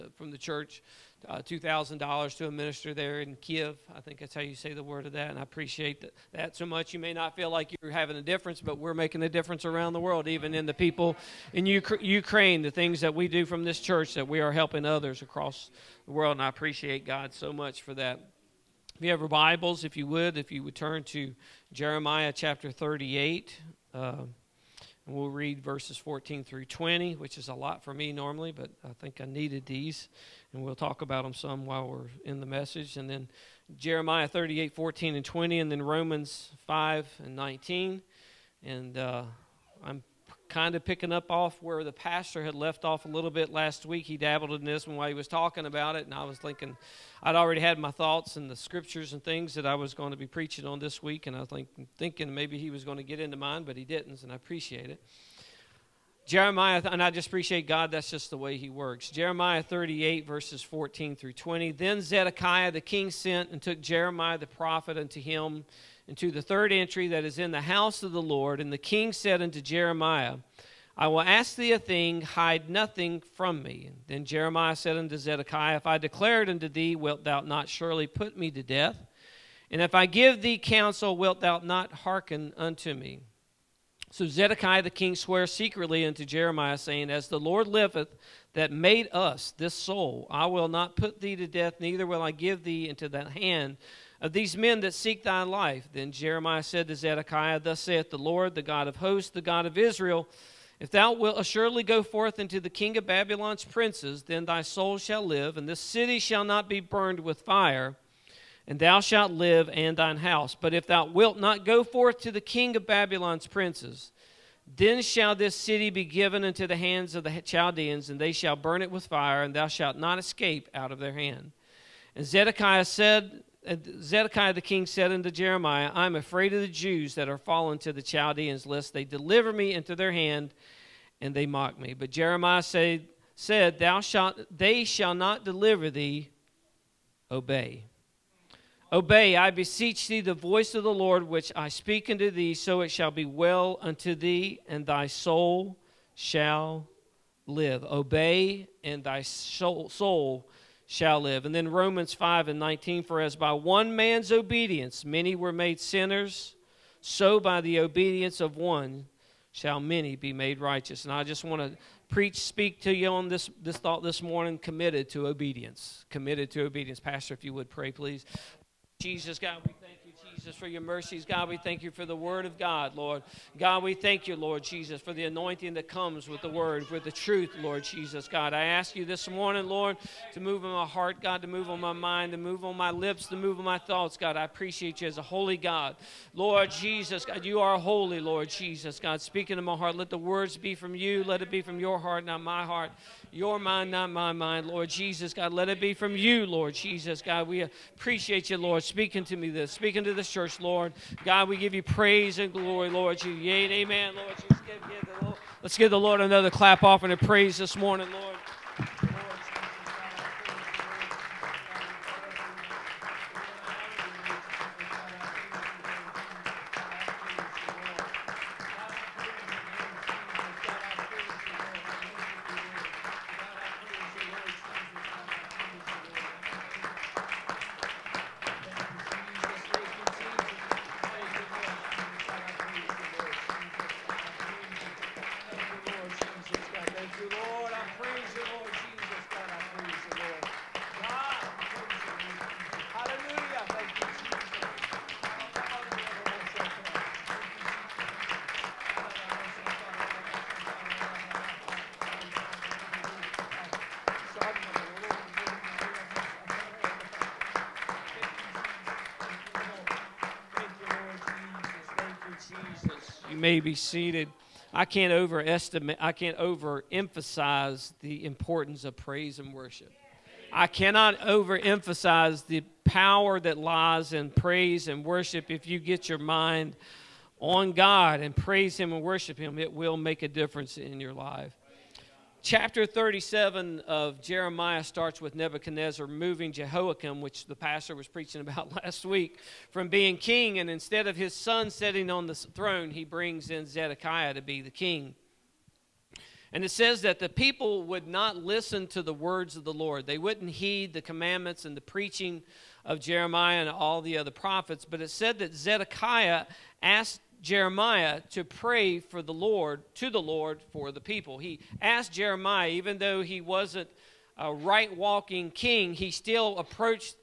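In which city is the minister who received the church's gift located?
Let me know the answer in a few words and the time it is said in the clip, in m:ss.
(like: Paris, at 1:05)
Kiev, at 0:03.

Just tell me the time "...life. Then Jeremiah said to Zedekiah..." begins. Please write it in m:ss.
1:35.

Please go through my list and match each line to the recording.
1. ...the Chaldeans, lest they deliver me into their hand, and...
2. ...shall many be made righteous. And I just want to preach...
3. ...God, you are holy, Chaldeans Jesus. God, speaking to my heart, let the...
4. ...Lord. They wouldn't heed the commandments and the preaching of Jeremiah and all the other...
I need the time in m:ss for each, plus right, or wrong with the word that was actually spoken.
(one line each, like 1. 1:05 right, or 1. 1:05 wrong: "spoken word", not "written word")
1. 2:07 right
2. 2:39 right
3. 3:07 wrong: "Lord", not "Chaldeans"
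4. 4:59 right.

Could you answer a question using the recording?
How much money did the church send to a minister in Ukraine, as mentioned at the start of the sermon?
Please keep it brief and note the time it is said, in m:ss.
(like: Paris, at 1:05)
$2,000, at 0:01.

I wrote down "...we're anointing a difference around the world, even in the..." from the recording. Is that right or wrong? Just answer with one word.
wrong.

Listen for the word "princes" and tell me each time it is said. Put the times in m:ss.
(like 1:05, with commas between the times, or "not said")
1:43, 1:53.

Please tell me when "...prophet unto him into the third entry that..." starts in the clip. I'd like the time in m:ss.
1:04.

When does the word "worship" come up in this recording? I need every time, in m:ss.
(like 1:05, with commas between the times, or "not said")
4:29, 4:35, 4:39.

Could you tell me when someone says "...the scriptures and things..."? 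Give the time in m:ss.
0:48.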